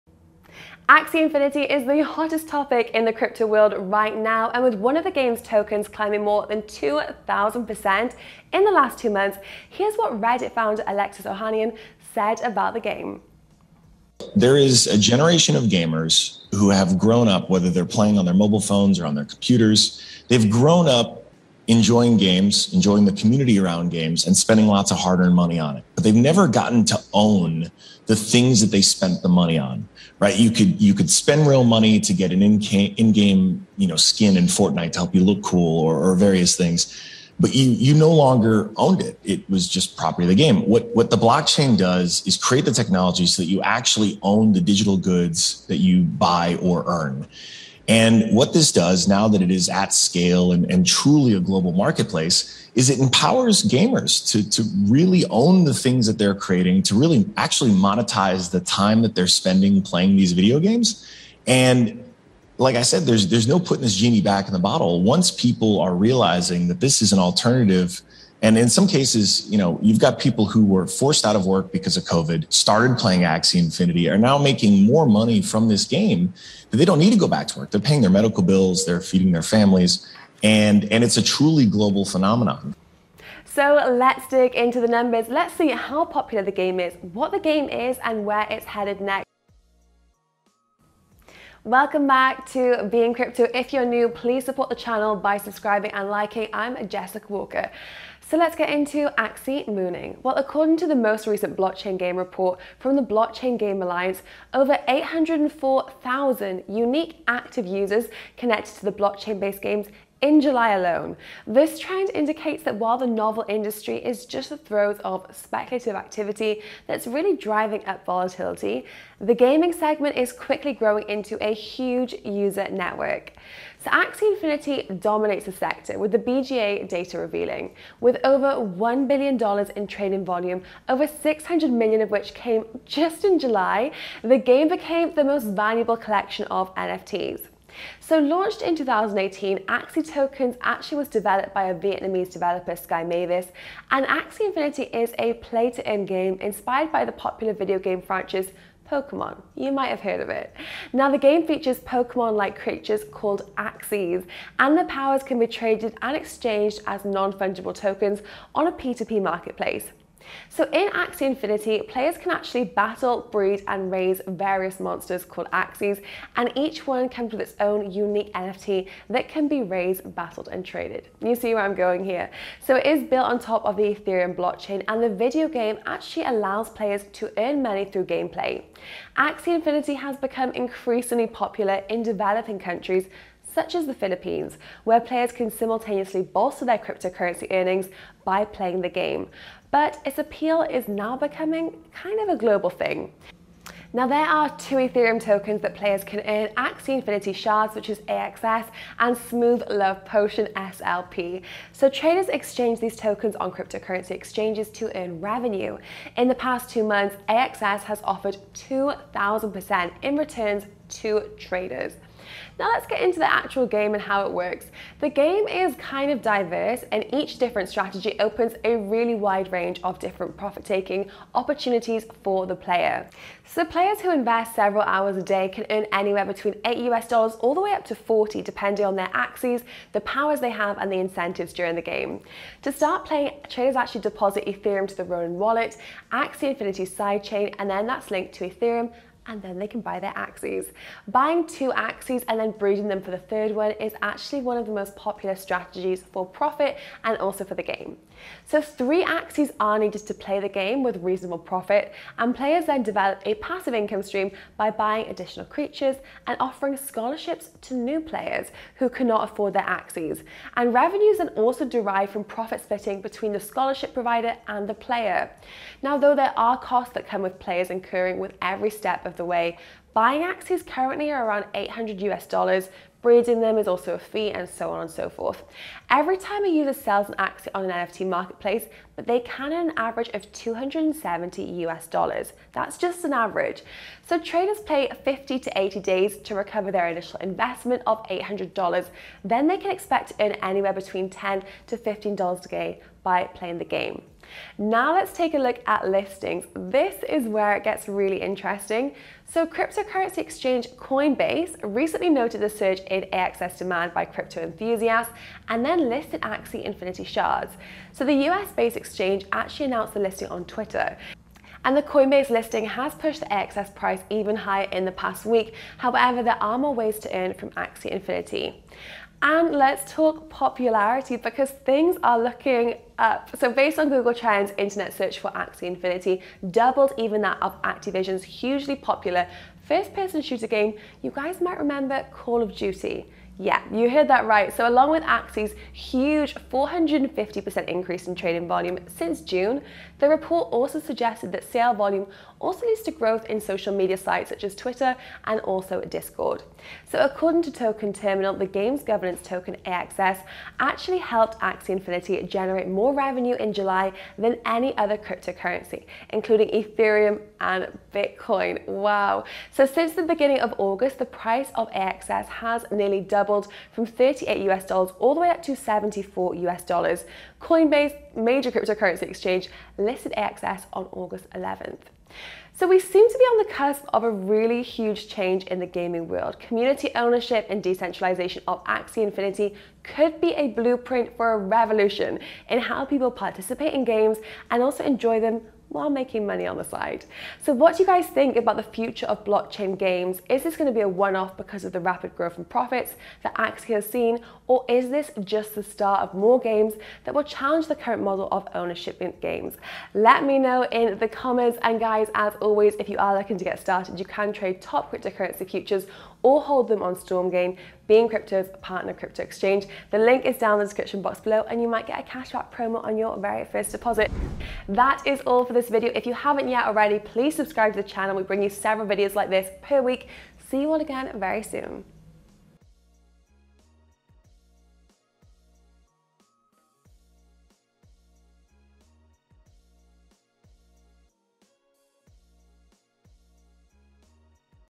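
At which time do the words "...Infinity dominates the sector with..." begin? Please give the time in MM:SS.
02:04.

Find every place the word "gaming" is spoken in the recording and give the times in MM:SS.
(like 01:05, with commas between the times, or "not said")
01:59, 06:15.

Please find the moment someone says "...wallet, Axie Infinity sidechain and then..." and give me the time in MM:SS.
03:55.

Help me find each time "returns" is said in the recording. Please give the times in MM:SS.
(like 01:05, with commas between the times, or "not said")
03:30.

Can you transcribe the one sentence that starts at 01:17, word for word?
They're paying their medical bills, they're feeding their families, and and it's a truly global phenomenon.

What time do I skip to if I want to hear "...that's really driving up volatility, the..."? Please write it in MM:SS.
01:56.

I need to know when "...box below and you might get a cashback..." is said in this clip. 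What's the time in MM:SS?
06:51.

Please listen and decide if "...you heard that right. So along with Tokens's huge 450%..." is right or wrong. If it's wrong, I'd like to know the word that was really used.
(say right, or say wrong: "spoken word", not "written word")
wrong: "Axie", not "Tokens".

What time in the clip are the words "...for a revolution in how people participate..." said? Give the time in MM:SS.
06:21.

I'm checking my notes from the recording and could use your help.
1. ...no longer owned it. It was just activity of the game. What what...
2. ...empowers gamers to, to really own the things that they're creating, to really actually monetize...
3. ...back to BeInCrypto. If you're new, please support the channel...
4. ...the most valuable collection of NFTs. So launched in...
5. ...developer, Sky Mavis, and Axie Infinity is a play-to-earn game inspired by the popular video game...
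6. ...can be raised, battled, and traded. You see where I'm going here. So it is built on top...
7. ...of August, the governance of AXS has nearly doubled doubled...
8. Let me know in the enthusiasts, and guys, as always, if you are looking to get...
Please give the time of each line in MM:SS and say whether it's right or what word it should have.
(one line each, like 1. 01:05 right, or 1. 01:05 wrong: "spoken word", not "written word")
1. 00:37 wrong: "property", not "activity"
2. 00:52 right
3. 01:32 right
4. 02:15 right
5. 02:22 right
6. 02:49 right
7. 06:00 wrong: "price", not "governance"
8. 06:39 wrong: "comments", not "enthusiasts".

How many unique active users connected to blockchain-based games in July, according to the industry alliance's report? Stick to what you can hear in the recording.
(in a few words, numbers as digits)
804,000.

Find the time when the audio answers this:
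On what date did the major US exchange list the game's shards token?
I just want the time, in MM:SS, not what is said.
06:10.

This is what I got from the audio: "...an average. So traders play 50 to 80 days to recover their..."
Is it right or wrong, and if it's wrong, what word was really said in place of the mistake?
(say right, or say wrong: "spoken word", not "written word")
right.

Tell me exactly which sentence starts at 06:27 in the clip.
So what do you guys think about the future of blockchain games?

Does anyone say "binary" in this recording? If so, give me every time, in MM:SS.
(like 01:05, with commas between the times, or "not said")
not said.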